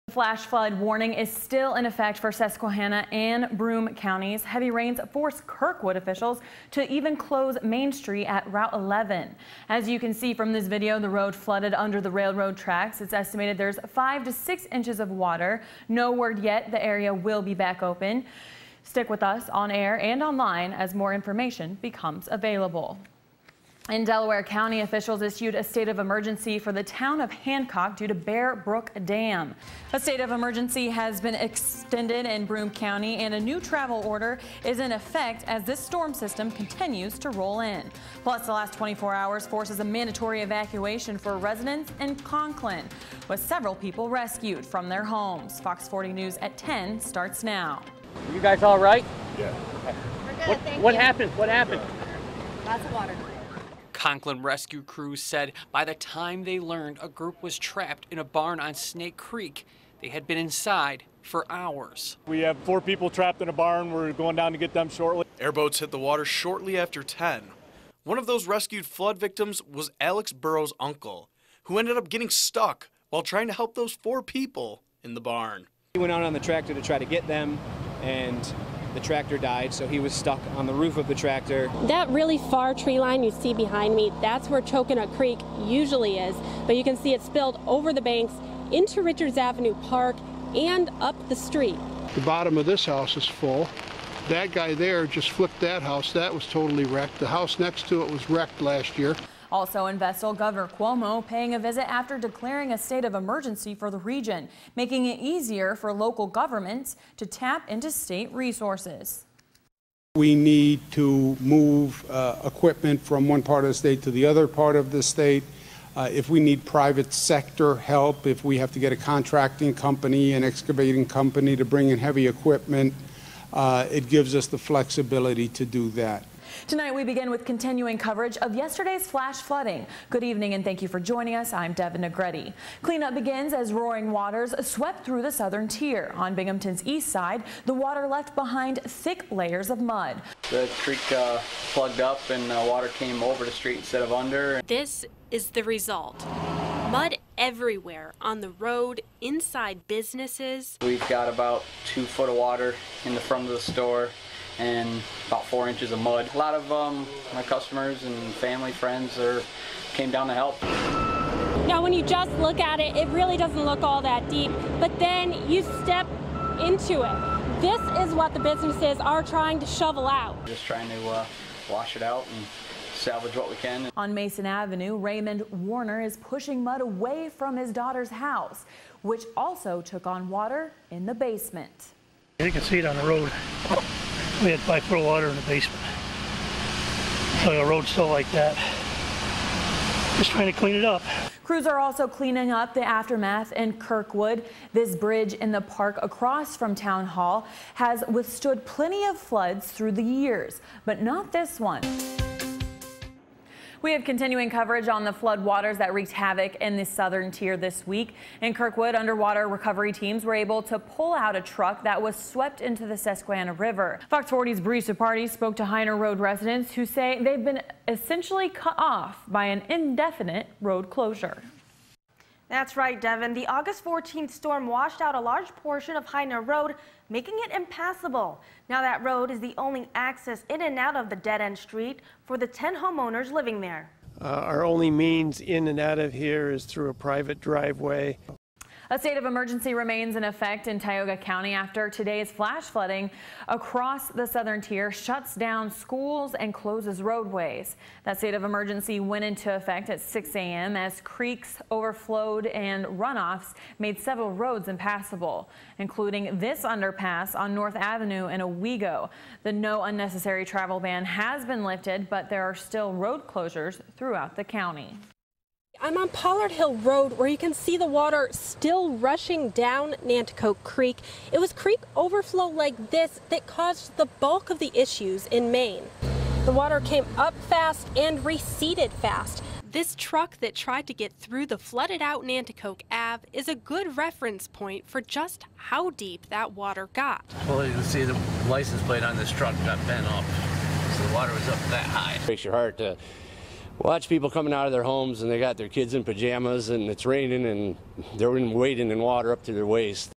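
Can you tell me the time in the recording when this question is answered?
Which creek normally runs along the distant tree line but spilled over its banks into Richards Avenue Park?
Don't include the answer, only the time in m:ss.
1:24.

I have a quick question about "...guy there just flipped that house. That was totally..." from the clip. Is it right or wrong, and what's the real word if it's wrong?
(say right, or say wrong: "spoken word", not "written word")
right.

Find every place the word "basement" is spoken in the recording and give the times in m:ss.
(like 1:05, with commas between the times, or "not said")
3:01, 3:05.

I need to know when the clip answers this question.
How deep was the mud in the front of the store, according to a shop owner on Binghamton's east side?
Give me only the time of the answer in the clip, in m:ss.
2:35.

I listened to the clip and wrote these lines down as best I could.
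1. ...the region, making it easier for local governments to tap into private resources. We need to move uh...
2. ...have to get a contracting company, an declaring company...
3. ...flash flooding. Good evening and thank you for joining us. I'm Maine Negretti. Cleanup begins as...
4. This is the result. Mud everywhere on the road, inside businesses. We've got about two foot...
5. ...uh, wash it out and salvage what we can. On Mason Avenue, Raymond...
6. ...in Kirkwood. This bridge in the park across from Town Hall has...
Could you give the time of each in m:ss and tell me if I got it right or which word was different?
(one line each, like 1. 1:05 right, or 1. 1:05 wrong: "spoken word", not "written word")
1. 1:43 wrong: "state", not "private"
2. 1:58 wrong: "excavating", not "declaring"
3. 2:09 wrong: "Devin", not "Maine"
4. 2:24 right
5. 2:51 right
6. 3:13 right.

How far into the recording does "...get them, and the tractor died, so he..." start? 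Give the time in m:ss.
1:17.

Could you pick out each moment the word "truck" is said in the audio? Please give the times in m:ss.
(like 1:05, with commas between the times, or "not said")
3:31, 4:39, 4:49.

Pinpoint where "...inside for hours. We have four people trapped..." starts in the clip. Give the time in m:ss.
1:00.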